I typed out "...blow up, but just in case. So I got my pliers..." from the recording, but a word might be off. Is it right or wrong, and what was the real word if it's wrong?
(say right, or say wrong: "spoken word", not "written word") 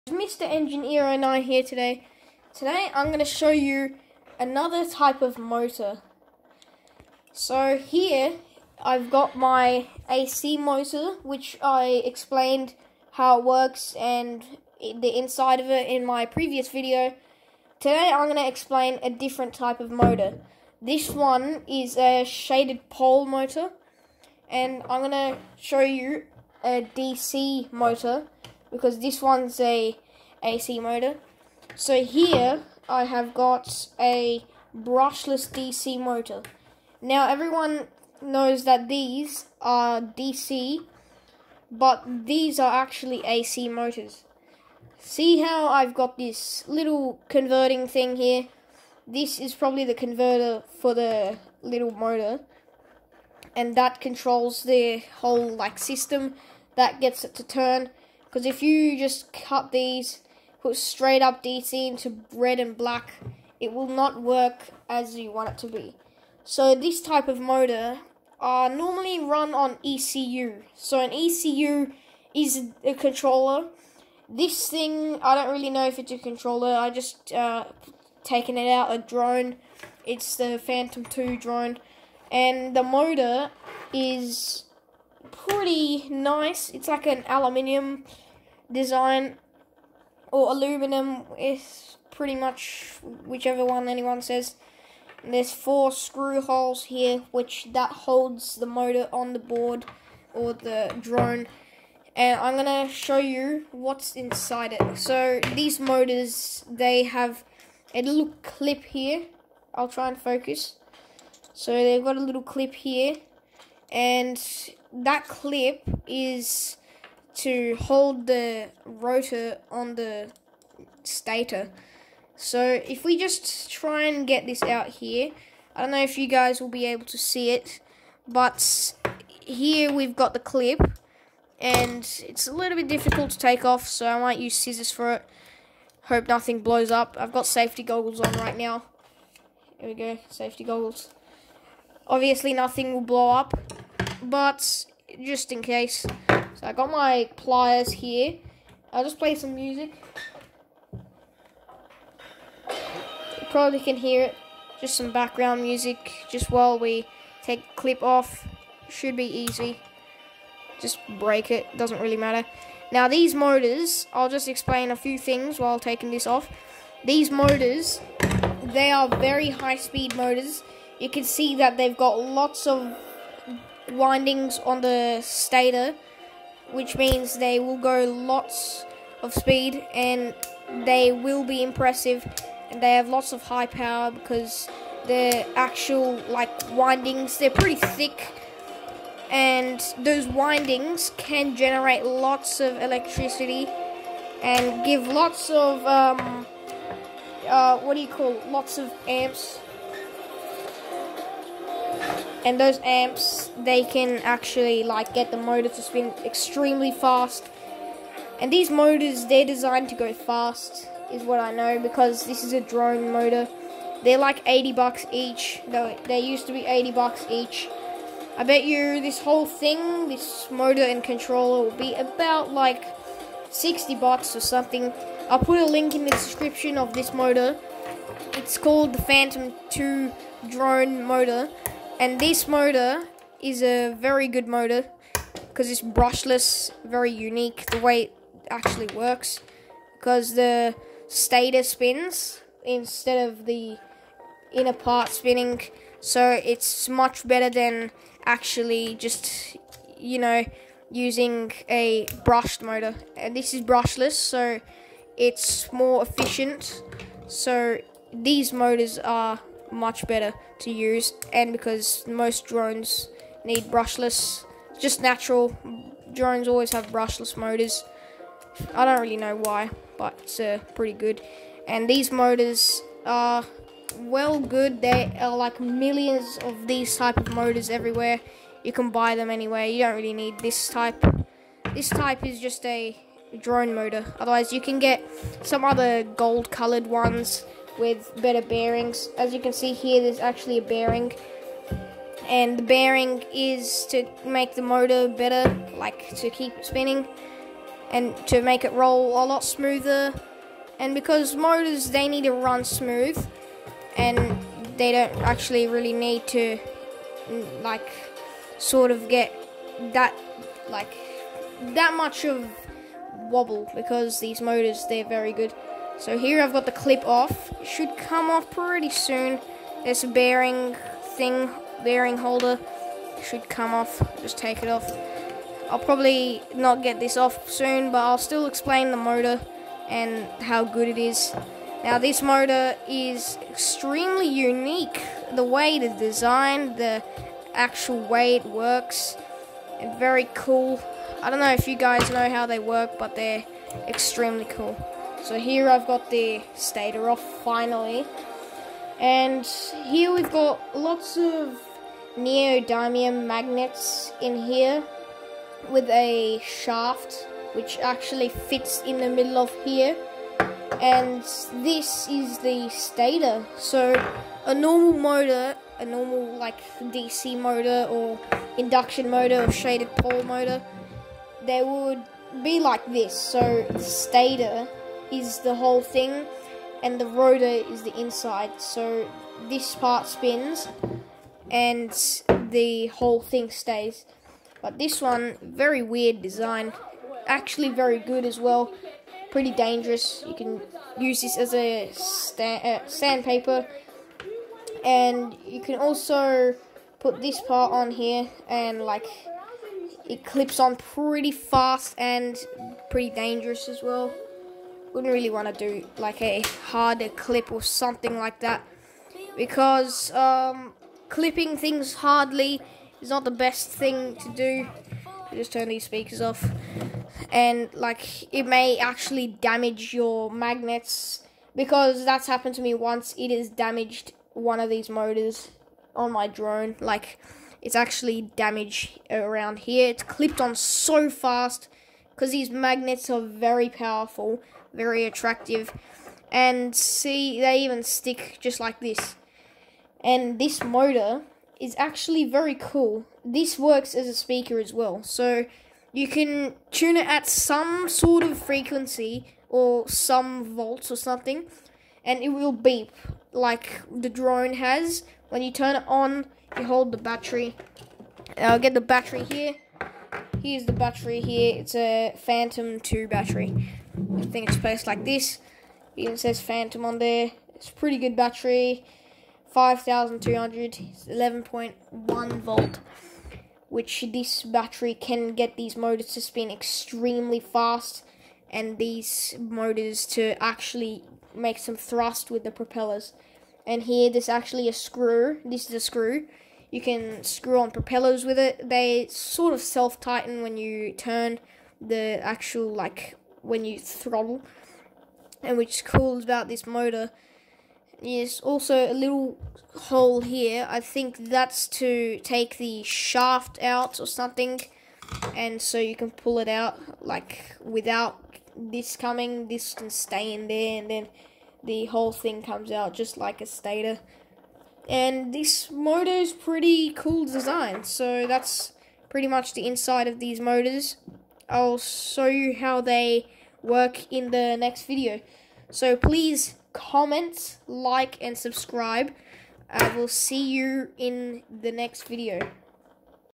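right.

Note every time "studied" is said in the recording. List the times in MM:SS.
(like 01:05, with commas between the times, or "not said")
not said.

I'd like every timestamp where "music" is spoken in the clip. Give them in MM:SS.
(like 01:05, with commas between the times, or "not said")
02:29, 02:35.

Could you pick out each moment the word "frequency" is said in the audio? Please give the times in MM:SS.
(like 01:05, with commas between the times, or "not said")
07:28.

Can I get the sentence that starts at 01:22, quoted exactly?
And the motor is pretty nice.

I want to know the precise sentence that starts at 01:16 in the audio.
I just uh, taken it out a drone.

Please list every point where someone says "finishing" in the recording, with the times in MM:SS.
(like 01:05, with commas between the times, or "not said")
not said.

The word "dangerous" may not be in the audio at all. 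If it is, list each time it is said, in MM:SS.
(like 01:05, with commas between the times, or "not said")
06:29, 06:43.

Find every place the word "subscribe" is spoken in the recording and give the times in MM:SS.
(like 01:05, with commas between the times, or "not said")
08:48.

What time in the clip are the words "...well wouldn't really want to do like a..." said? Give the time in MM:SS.
06:43.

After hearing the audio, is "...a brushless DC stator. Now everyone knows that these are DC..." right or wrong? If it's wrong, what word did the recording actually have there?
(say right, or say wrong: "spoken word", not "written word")
wrong: "motor", not "stator".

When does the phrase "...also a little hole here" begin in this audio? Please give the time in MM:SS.
08:18.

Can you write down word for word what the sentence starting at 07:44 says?
I think it's placed like this.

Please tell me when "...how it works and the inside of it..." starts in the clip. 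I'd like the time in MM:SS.
00:13.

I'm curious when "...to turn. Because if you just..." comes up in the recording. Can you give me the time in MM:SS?
00:57.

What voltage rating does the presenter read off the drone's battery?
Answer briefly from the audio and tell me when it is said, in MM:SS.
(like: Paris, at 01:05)
11.1 volts, at 07:50.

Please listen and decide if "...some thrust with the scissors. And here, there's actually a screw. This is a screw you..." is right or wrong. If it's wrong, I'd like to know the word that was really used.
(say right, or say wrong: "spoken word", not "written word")
wrong: "propellers", not "scissors".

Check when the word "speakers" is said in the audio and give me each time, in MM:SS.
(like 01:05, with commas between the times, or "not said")
06:55, 07:24.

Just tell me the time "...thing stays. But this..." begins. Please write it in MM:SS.
06:23.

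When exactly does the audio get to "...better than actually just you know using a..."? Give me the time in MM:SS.
04:07.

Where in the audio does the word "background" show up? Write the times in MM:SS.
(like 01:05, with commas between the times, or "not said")
02:35.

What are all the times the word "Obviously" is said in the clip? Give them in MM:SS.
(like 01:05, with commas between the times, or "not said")
02:22.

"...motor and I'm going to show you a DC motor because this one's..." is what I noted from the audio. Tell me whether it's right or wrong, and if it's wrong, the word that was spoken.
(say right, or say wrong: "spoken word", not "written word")
right.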